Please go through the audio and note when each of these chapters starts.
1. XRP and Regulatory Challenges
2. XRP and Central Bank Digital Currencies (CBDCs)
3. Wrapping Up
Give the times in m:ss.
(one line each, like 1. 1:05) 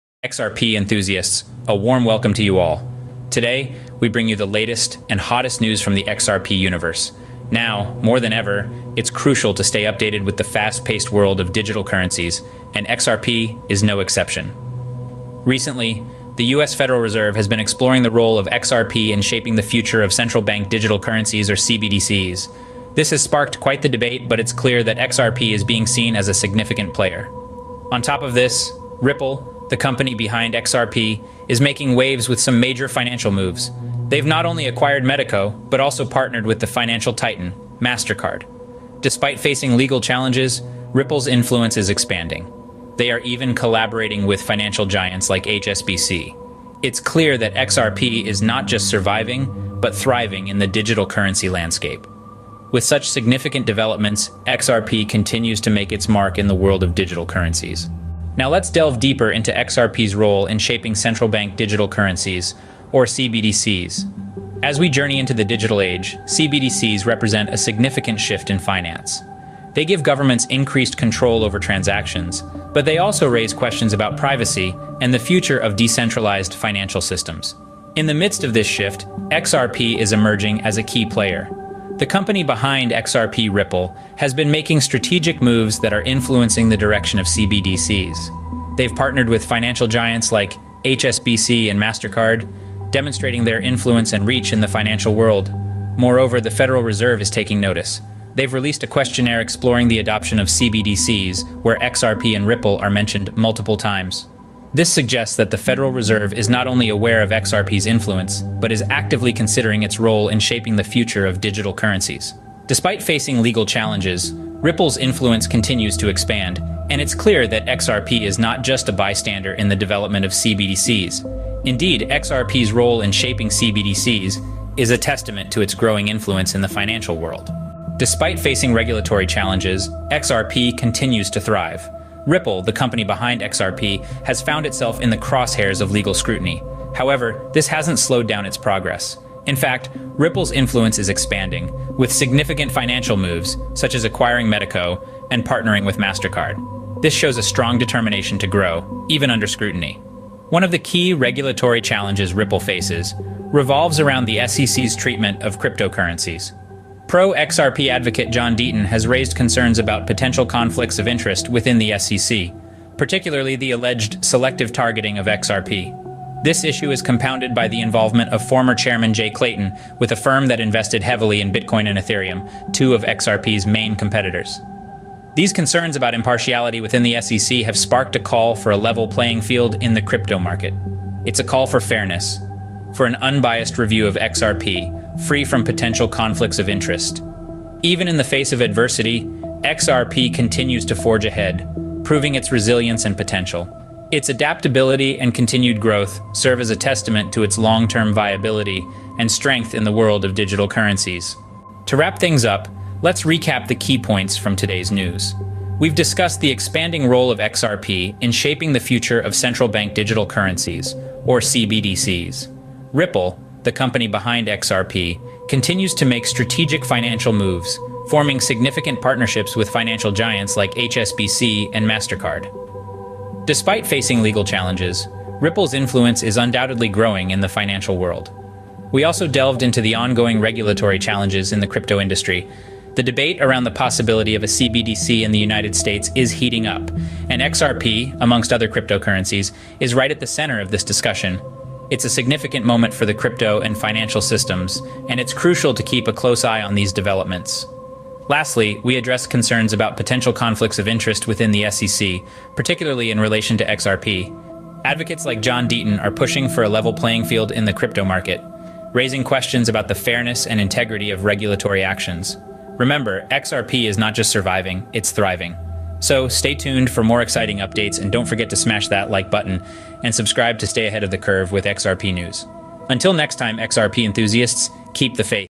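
1. 2:07
2. 0:58
3. 3:21.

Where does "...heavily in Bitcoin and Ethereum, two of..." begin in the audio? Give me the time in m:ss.
2:51.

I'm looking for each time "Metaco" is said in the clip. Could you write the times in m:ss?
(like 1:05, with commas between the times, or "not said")
0:35, 2:24.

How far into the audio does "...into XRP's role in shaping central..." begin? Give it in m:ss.
0:59.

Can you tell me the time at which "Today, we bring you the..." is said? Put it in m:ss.
0:03.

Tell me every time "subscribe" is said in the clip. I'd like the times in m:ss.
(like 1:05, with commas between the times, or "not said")
4:30.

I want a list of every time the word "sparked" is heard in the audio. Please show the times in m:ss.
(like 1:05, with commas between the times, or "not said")
0:23, 2:57.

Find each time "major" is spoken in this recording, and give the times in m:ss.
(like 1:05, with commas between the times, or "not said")
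0:32.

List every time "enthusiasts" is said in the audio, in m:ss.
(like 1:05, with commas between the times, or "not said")
0:00, 4:34.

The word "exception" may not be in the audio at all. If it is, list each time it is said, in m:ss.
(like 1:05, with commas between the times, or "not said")
0:13.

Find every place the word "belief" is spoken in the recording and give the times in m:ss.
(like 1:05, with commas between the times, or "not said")
not said.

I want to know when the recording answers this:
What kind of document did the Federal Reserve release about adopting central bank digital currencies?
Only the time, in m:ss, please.
1:38.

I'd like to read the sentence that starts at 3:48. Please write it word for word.
We also delved into the ongoing regulatory challenges in the crypto industry.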